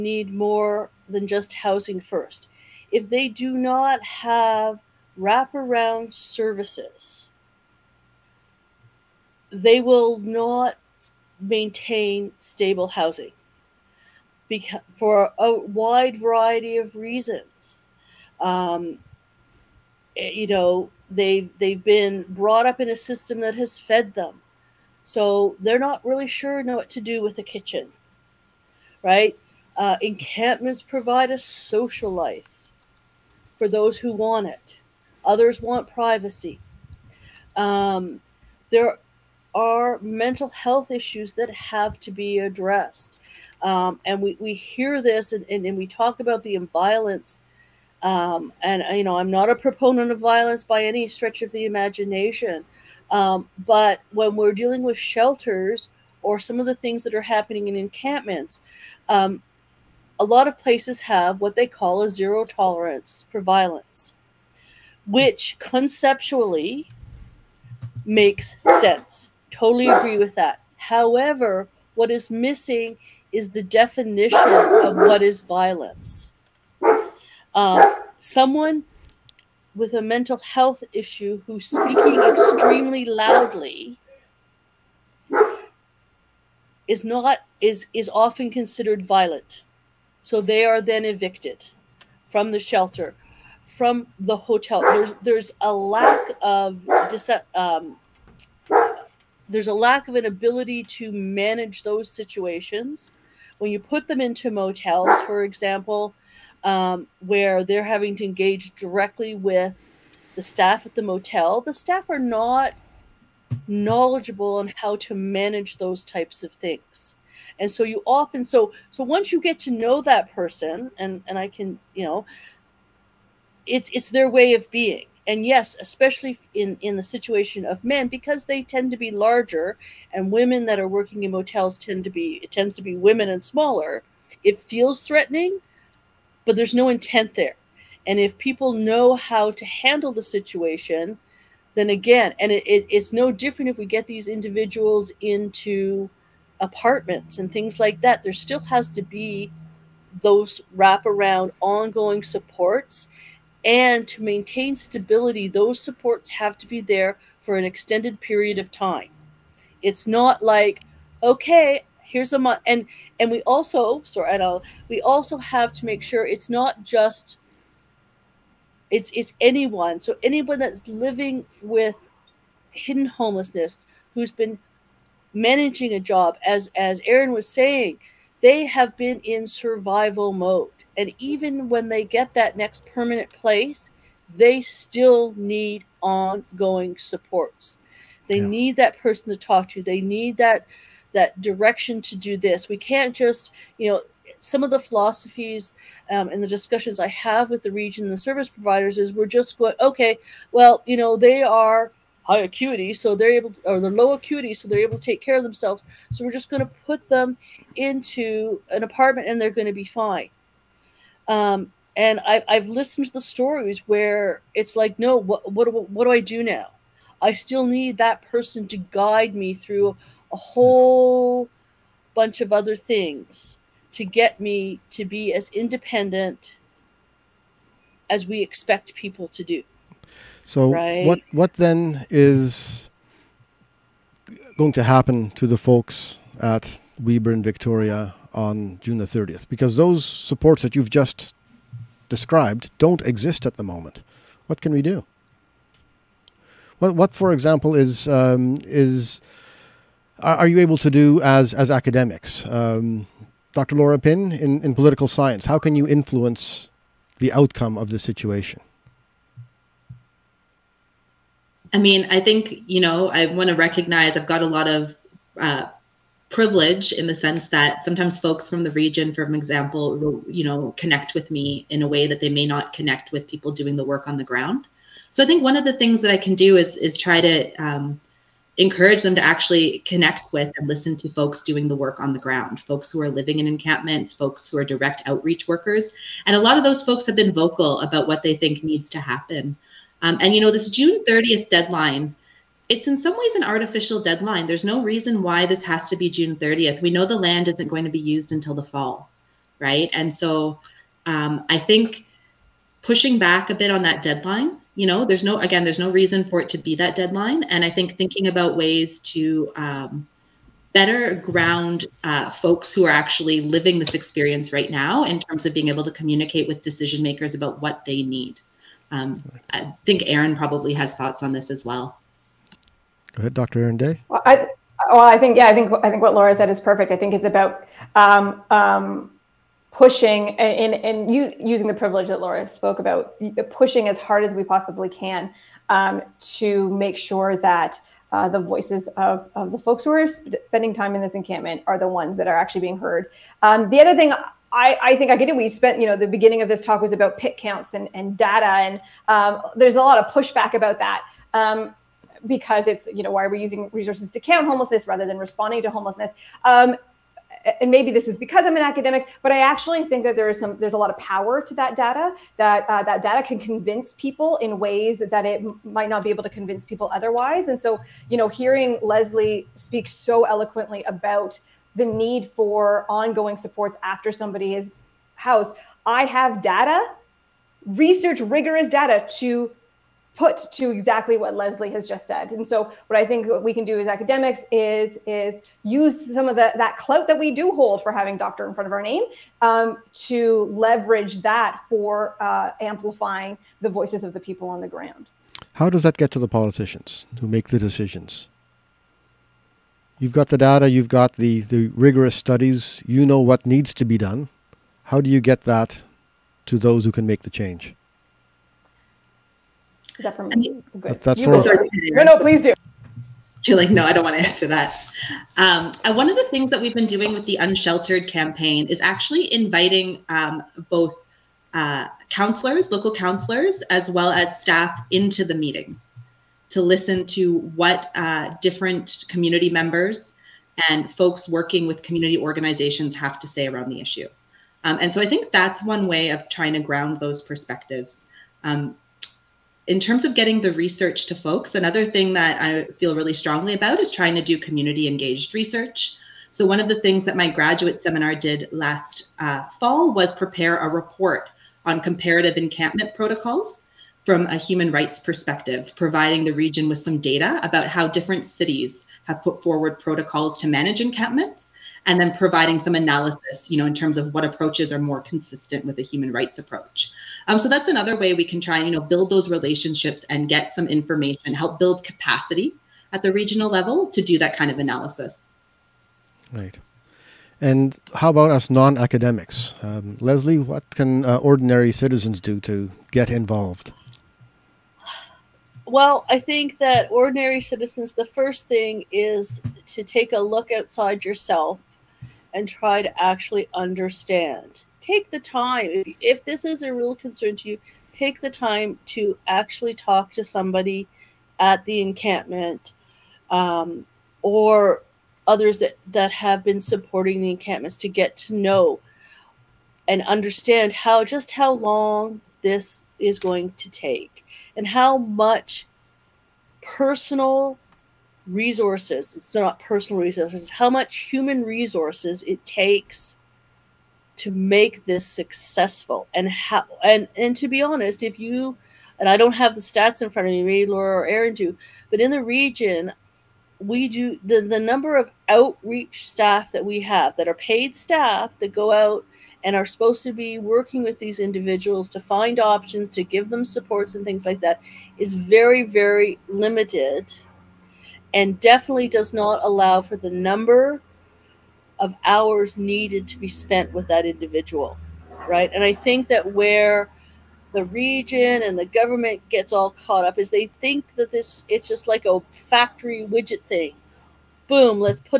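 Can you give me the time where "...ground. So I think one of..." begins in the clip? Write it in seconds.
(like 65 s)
274 s.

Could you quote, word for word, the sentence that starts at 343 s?
Um, the other thing I, I, think I get it.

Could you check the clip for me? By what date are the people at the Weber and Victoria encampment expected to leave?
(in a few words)
June 30.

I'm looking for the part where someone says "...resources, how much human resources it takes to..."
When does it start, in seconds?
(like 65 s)
520 s.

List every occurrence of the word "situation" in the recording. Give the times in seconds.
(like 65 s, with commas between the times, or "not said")
102 s, 127 s, 140 s, 257 s.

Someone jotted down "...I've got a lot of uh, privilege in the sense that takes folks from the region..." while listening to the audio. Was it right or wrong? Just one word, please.
wrong.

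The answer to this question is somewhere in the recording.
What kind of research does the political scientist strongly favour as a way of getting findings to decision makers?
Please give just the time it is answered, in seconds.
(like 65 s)
444 s.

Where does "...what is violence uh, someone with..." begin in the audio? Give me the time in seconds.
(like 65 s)
74 s.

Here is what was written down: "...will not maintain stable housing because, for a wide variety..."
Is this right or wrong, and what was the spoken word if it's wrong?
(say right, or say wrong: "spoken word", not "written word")
right.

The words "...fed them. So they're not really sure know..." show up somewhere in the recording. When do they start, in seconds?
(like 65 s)
23 s.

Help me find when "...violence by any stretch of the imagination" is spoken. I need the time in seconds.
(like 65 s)
50 s.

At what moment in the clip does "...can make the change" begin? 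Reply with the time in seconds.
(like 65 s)
406 s.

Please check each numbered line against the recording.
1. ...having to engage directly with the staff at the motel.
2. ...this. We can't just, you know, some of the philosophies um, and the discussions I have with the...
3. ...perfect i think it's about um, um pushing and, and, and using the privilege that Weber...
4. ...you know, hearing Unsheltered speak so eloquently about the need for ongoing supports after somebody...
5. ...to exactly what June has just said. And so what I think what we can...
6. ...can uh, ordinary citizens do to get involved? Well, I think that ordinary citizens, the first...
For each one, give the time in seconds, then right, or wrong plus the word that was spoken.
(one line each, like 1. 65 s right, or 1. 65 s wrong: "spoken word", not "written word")
1. 107 s right
2. 192 s right
3. 326 s wrong: "Laura", not "Weber"
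4. 368 s wrong: "Lesley", not "Unsheltered"
5. 380 s wrong: "Lesley", not "June"
6. 480 s right.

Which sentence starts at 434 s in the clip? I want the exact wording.
Um, and so I think that's one way of trying to ground those perspectives.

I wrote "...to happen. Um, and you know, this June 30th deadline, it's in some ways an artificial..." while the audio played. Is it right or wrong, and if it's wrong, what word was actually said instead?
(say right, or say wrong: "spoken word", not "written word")
right.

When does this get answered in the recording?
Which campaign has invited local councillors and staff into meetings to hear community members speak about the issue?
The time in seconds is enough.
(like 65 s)
417 s.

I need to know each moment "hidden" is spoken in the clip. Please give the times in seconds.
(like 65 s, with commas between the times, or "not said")
172 s.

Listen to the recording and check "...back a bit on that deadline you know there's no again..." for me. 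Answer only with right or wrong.
right.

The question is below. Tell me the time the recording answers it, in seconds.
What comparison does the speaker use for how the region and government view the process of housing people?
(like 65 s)
562 s.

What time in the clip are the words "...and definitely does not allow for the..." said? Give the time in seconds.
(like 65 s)
548 s.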